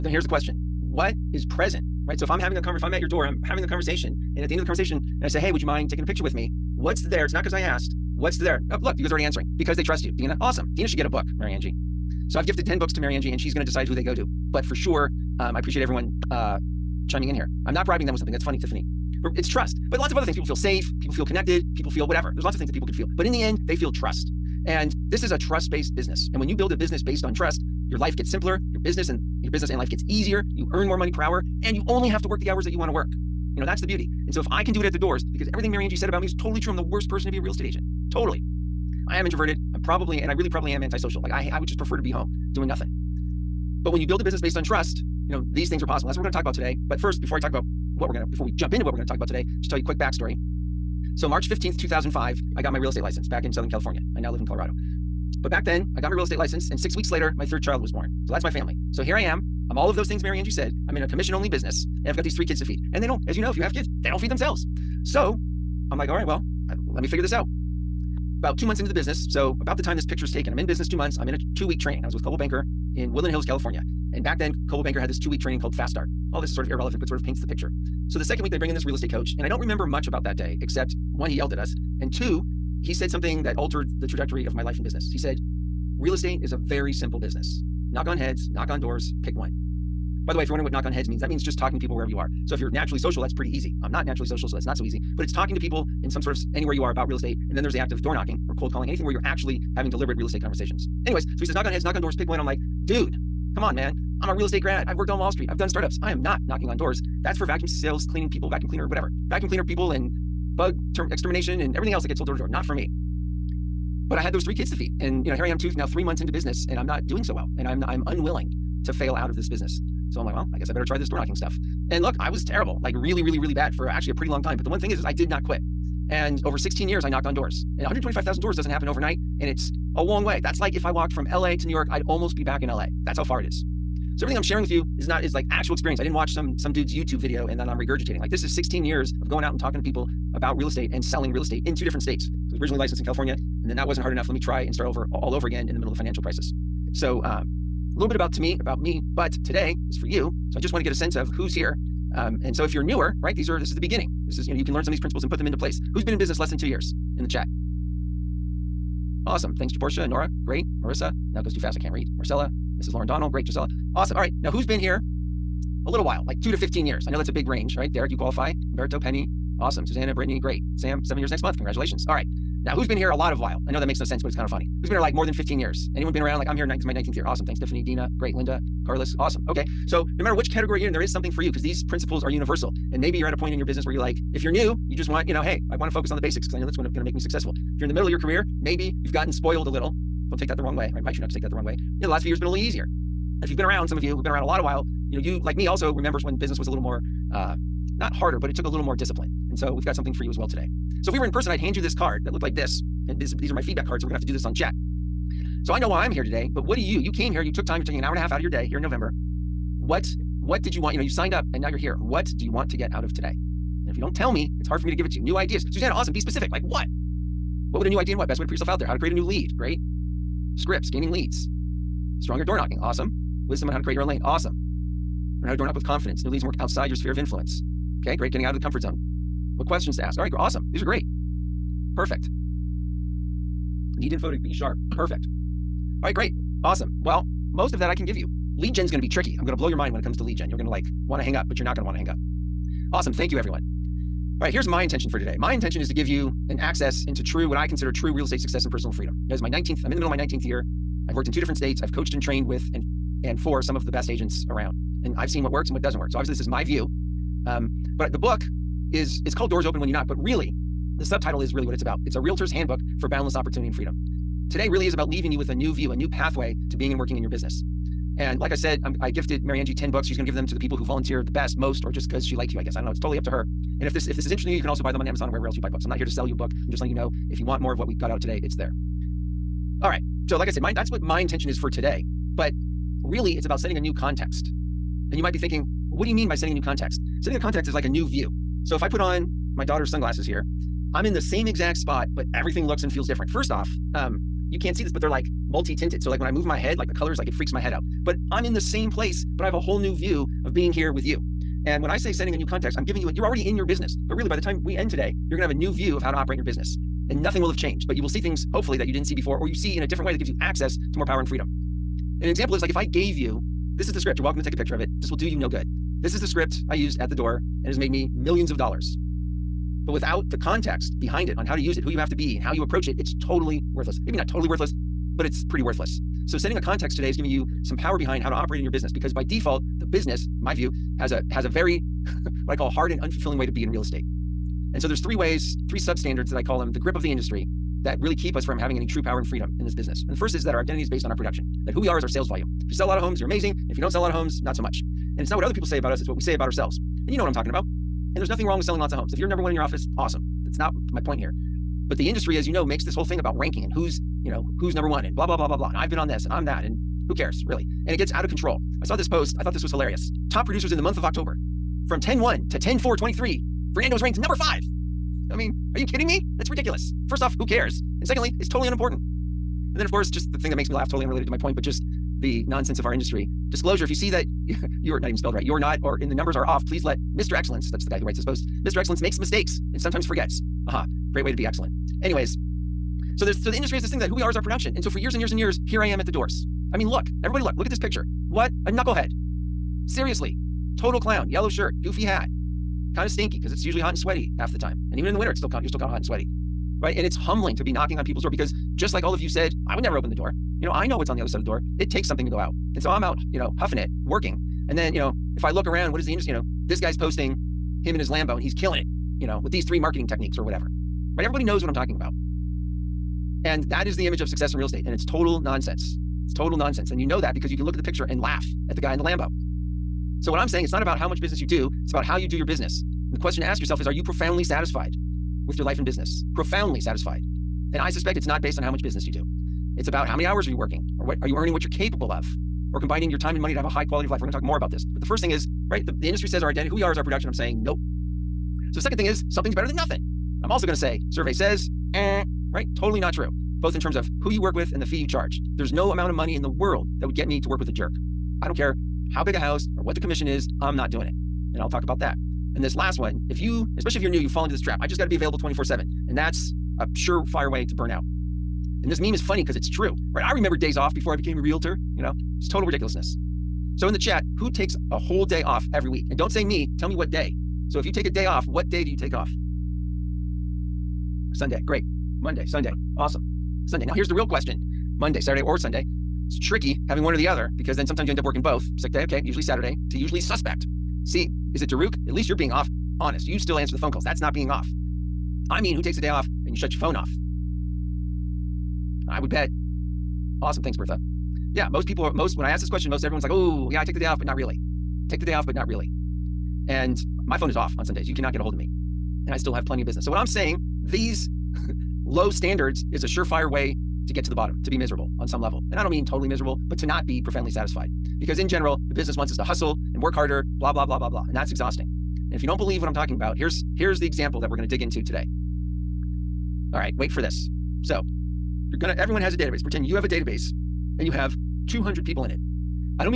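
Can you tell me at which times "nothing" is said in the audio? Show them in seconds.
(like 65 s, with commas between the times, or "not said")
42 s, 307 s, 348 s, 439 s.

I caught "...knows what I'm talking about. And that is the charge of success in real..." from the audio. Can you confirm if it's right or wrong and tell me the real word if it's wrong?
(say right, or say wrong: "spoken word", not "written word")
wrong: "image", not "charge".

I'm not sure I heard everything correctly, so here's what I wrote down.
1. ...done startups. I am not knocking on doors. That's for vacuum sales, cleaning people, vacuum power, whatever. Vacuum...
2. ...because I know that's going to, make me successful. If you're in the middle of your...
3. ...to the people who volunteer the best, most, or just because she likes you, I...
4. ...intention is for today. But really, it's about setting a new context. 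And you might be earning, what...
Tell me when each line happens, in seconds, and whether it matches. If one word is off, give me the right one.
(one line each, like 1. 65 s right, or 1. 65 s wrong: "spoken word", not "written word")
1. 105 s wrong: "cleaner", not "power"
2. 186 s right
3. 270 s right
4. 281 s wrong: "thinking", not "earning".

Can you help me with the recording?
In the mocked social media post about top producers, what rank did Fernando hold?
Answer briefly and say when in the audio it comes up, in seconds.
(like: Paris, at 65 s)
number five, at 364 s.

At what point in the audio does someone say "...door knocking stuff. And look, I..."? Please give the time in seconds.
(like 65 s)
121 s.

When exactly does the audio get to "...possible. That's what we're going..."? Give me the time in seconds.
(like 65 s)
45 s.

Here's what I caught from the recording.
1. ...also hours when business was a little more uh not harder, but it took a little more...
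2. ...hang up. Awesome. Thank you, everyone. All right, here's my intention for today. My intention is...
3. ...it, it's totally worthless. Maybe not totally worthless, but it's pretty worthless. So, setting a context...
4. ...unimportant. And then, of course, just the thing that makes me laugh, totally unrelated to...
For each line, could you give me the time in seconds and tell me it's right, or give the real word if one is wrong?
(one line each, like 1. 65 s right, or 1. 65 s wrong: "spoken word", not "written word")
1. 195 s wrong: "remembers", not "hours"
2. 241 s right
3. 322 s right
4. 368 s right.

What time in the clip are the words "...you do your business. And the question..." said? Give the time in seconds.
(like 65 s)
422 s.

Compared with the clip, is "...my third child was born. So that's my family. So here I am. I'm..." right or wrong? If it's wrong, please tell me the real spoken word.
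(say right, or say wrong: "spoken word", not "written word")
right.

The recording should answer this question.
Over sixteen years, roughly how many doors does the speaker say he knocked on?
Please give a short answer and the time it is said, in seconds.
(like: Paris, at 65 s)
125,000, at 127 s.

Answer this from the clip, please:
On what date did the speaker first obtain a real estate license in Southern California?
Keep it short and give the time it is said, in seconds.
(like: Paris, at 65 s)
March 15th, 2005, at 51 s.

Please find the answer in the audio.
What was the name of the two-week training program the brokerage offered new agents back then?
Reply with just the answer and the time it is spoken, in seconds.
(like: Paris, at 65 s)
Fast Start, at 75 s.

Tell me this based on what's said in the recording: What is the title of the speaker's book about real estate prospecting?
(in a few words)
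Doors Open When You Knock.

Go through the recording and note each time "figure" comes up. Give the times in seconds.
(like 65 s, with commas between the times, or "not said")
67 s.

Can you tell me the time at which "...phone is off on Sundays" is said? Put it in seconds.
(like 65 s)
497 s.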